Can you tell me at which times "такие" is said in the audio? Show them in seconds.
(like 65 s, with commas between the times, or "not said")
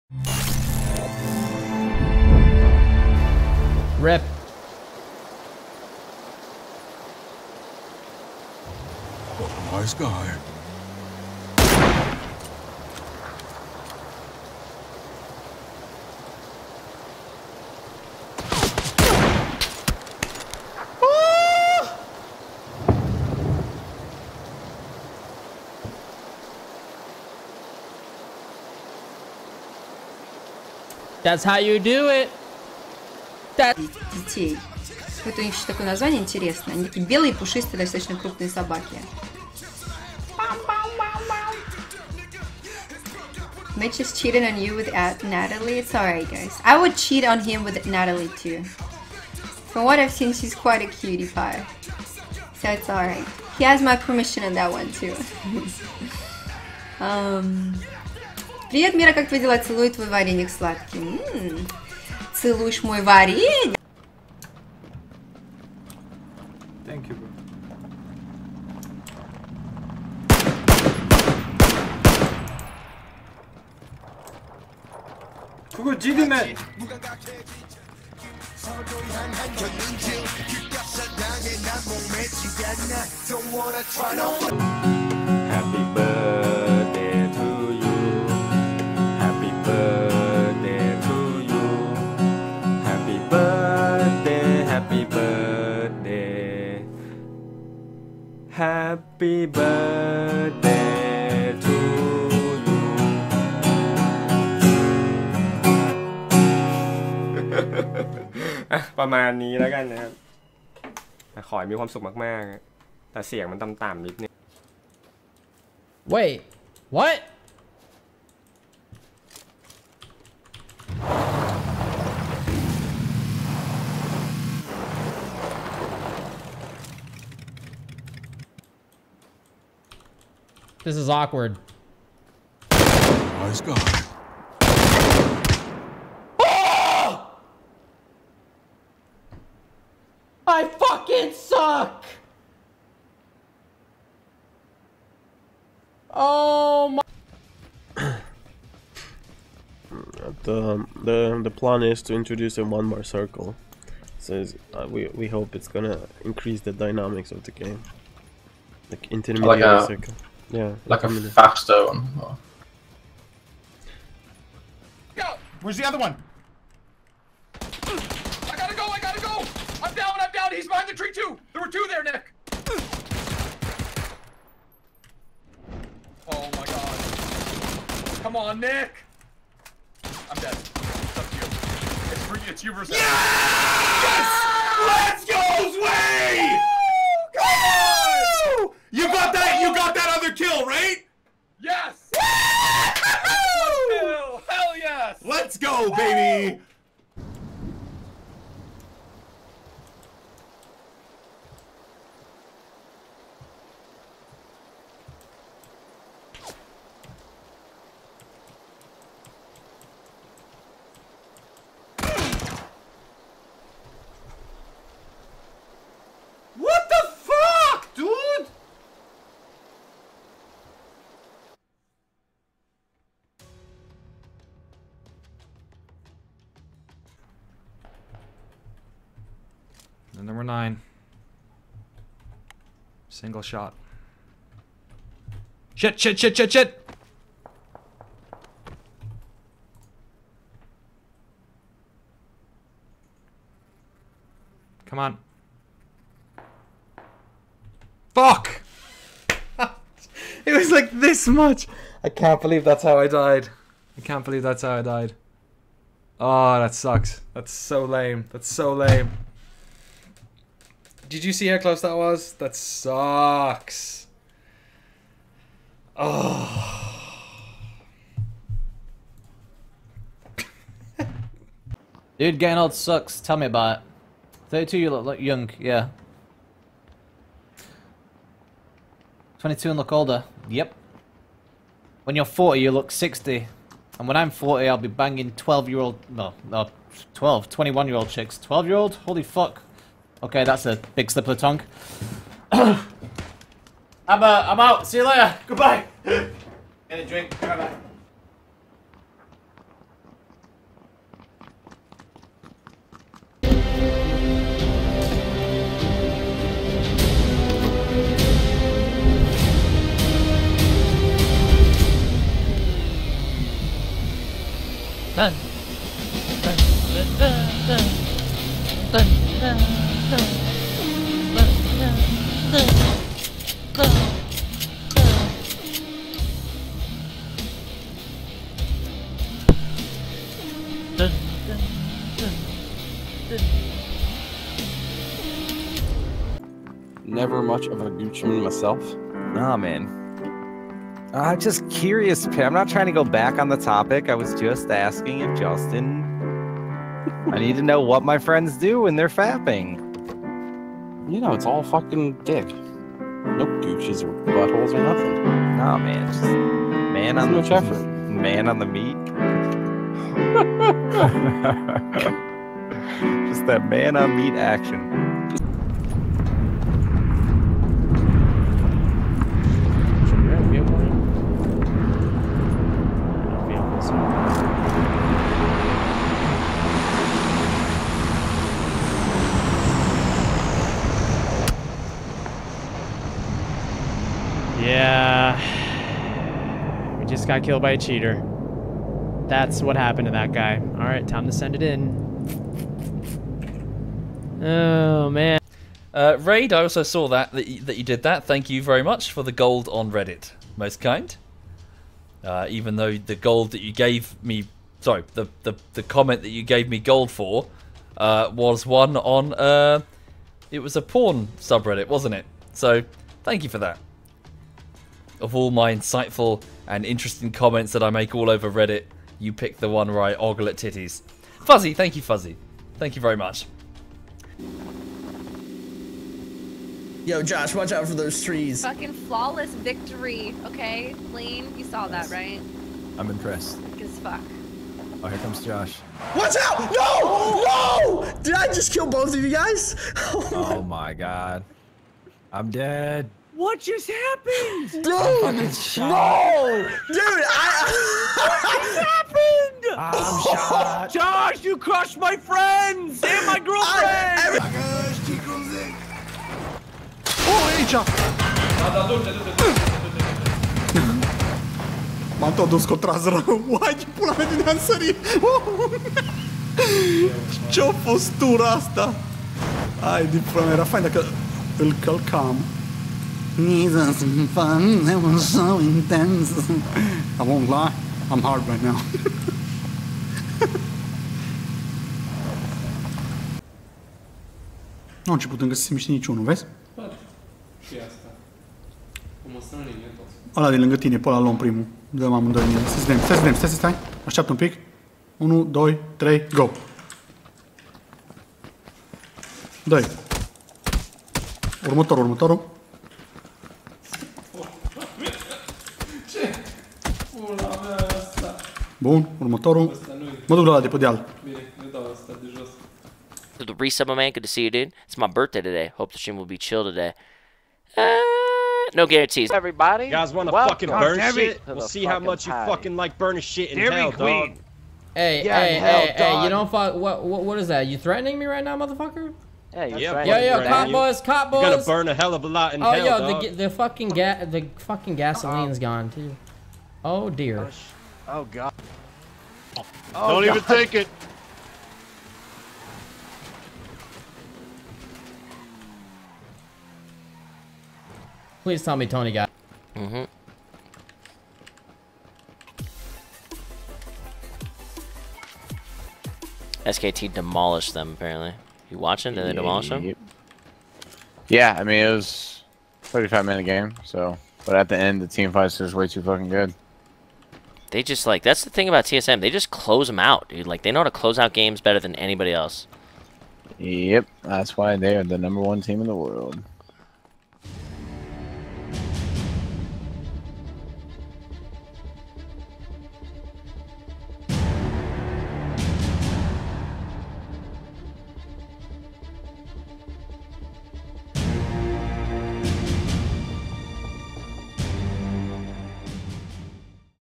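36 s.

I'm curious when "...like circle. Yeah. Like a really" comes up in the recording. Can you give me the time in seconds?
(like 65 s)
159 s.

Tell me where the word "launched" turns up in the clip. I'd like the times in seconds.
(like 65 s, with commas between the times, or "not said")
not said.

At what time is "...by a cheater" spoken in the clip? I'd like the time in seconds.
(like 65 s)
387 s.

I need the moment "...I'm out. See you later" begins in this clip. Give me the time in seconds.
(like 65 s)
294 s.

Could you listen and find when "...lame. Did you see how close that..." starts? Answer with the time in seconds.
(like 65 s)
258 s.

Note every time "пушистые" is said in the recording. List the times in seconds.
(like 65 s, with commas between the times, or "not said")
37 s.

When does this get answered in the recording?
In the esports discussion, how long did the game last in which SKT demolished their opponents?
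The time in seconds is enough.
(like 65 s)
562 s.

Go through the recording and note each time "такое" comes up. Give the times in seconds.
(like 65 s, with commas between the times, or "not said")
35 s.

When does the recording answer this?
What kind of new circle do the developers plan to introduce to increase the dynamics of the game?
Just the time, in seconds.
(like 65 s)
152 s.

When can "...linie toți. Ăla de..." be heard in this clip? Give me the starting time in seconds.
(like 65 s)
489 s.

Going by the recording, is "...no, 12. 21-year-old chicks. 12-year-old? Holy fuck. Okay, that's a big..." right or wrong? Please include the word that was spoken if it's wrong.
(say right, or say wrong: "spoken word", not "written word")
right.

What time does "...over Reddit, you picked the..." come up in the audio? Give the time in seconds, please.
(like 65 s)
418 s.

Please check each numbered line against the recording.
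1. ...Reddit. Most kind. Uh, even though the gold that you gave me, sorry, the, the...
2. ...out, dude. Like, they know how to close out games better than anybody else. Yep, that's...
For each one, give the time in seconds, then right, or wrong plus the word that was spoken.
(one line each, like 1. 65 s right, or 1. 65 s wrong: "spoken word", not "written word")
1. 399 s right
2. 569 s right.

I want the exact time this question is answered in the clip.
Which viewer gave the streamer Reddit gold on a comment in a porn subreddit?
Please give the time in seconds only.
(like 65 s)
396 s.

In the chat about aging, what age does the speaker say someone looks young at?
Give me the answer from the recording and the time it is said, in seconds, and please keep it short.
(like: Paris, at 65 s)
32, at 274 s.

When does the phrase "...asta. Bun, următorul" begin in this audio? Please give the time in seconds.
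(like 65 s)
507 s.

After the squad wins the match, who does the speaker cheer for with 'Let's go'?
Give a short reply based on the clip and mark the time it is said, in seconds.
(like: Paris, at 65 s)
Sway, at 185 s.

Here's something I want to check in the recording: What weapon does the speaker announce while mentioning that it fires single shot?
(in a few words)
The number nine.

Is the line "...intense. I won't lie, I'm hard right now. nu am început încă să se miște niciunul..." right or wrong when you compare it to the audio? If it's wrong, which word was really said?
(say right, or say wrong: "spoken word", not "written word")
right.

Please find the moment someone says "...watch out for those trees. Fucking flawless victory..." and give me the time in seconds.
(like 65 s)
427 s.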